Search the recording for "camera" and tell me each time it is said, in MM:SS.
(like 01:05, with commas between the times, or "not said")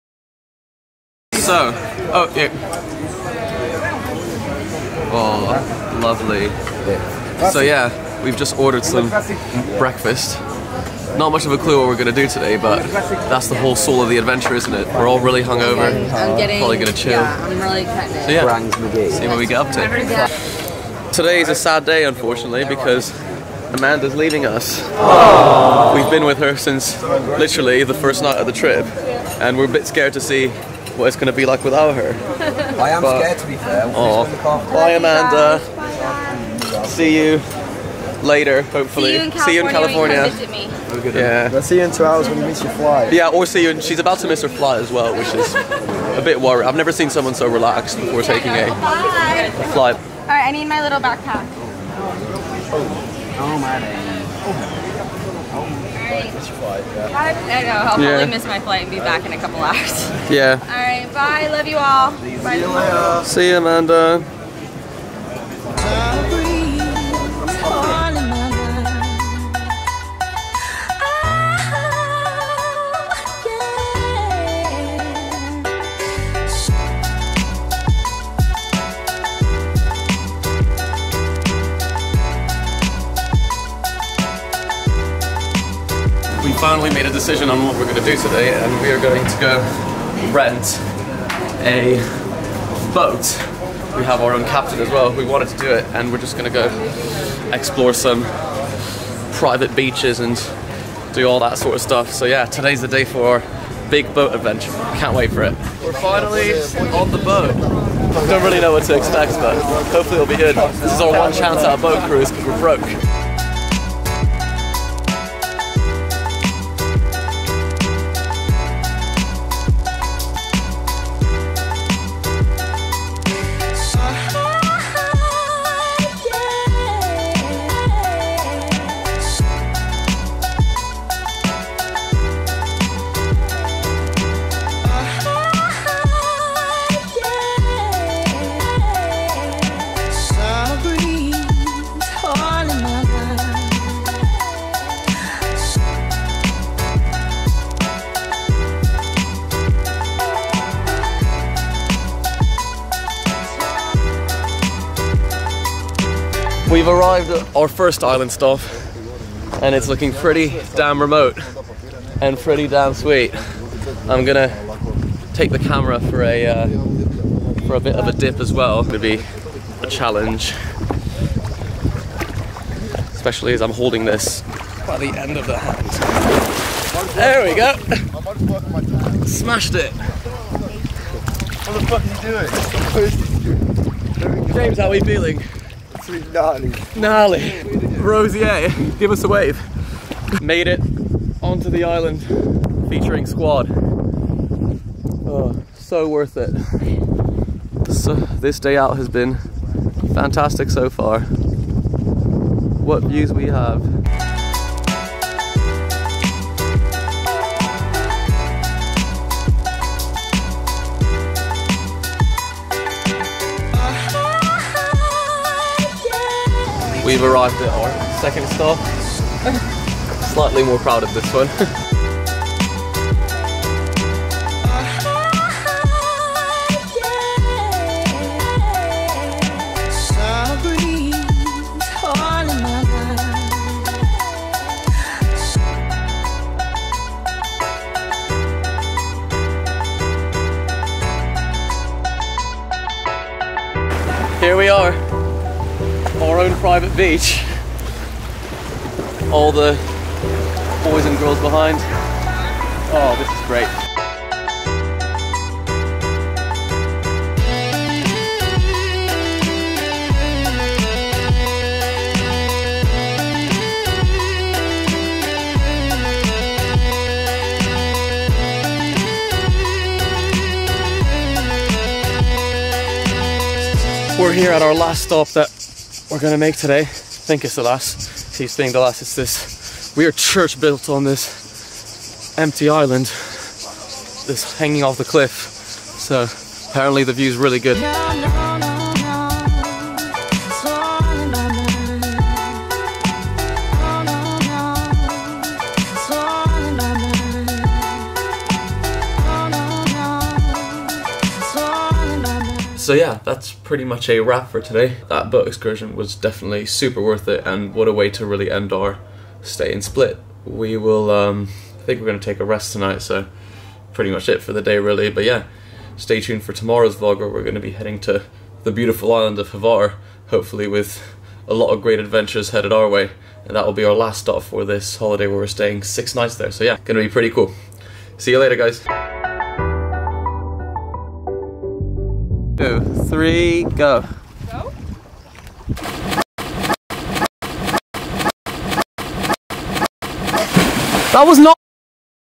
02:45.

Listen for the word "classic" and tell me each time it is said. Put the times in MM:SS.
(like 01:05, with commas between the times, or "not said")
not said.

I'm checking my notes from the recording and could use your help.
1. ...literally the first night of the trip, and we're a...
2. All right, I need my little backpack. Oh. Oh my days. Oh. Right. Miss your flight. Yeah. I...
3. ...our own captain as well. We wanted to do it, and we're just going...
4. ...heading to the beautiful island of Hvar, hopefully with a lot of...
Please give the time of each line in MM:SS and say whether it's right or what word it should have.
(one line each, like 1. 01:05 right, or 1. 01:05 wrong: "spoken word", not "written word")
1. 00:27 right
2. 00:49 right
3. 01:34 right
4. 05:17 right.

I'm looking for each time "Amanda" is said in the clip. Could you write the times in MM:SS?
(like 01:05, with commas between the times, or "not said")
00:23, 00:34, 01:03.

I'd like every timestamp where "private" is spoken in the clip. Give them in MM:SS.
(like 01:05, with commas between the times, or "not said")
01:39, 04:06.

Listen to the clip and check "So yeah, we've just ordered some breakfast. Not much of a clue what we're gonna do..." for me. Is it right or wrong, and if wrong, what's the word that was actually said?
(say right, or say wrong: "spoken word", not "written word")
right.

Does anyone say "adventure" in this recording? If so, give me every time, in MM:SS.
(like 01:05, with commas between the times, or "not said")
00:14, 01:44, 05:22.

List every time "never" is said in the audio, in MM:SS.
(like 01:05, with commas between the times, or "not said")
00:46.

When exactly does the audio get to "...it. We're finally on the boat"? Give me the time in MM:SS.
01:45.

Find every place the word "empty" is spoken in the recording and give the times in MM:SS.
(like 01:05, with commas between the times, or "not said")
04:42.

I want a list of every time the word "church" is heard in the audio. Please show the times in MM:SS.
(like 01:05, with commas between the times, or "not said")
04:40.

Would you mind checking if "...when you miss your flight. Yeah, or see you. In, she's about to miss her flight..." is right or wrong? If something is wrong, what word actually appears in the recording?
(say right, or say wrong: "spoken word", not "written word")
right.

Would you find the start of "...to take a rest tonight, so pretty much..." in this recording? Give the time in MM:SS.
05:12.